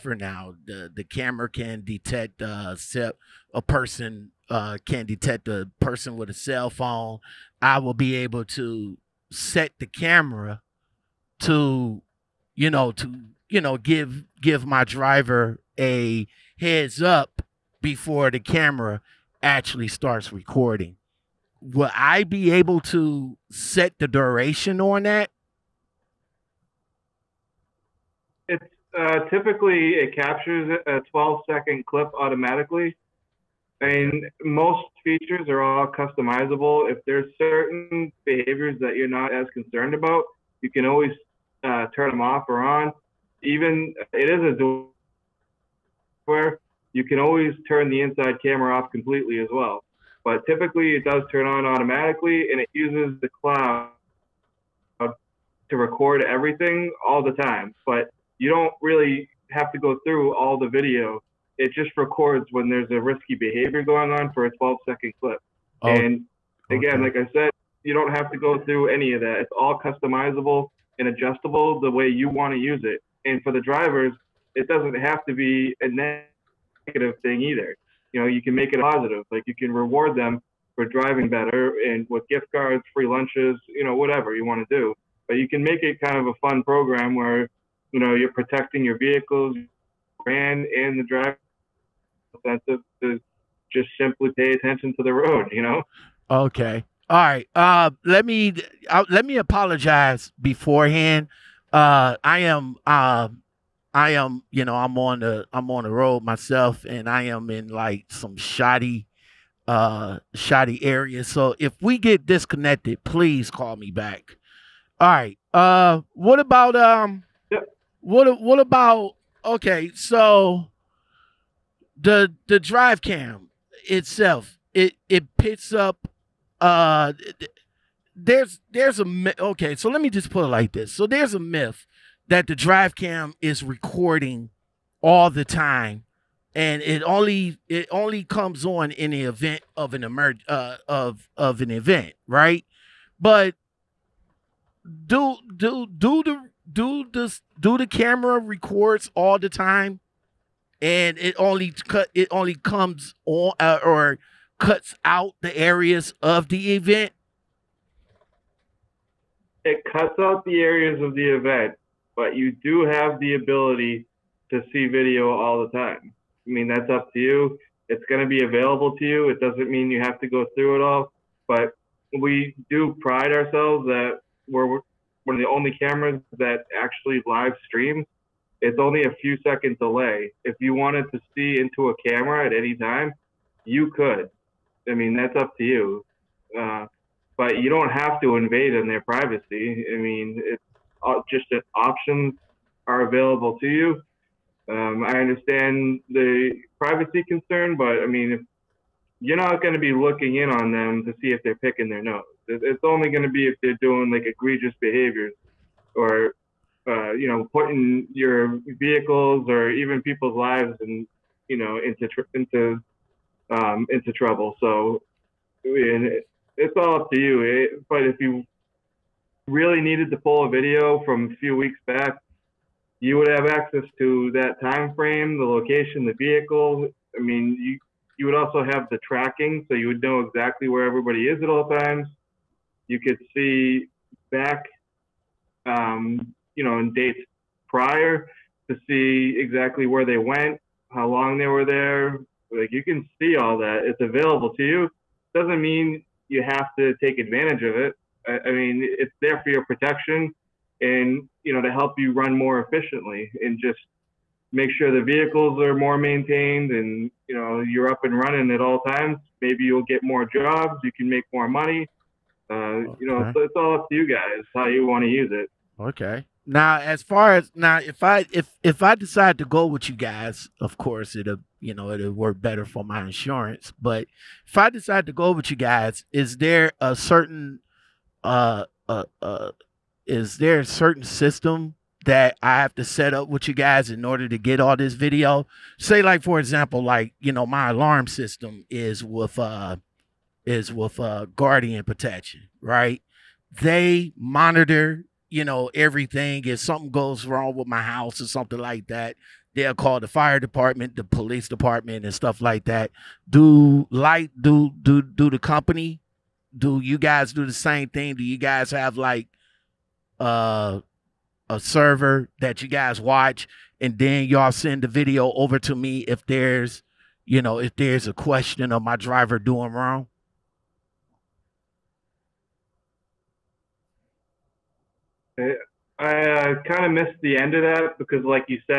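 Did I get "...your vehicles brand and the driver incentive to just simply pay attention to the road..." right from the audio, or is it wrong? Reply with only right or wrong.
right.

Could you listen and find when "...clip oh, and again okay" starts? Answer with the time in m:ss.
1:05.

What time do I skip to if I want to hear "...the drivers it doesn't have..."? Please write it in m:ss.
1:13.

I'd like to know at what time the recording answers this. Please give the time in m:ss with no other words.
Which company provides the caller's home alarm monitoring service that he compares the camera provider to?
4:51.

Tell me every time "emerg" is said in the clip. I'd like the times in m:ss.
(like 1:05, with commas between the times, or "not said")
2:20.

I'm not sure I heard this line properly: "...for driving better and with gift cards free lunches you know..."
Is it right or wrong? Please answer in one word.
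right.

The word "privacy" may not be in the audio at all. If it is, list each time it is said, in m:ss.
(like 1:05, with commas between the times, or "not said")
3:09, 3:16.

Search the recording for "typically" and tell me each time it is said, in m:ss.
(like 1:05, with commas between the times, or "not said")
0:29, 0:50.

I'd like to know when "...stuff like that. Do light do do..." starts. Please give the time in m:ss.
5:02.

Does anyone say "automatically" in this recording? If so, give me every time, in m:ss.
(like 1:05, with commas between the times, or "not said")
0:32, 0:51.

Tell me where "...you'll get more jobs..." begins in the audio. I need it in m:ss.
4:19.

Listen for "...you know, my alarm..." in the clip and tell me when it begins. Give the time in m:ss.
4:47.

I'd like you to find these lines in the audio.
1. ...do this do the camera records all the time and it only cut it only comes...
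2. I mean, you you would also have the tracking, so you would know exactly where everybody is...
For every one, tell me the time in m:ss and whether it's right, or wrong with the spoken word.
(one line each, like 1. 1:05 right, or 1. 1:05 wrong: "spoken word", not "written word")
1. 2:26 right
2. 3:47 right.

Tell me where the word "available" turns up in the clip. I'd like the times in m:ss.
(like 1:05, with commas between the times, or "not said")
2:48, 3:13, 4:03.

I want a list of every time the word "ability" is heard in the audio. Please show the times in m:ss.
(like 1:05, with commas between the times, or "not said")
2:43.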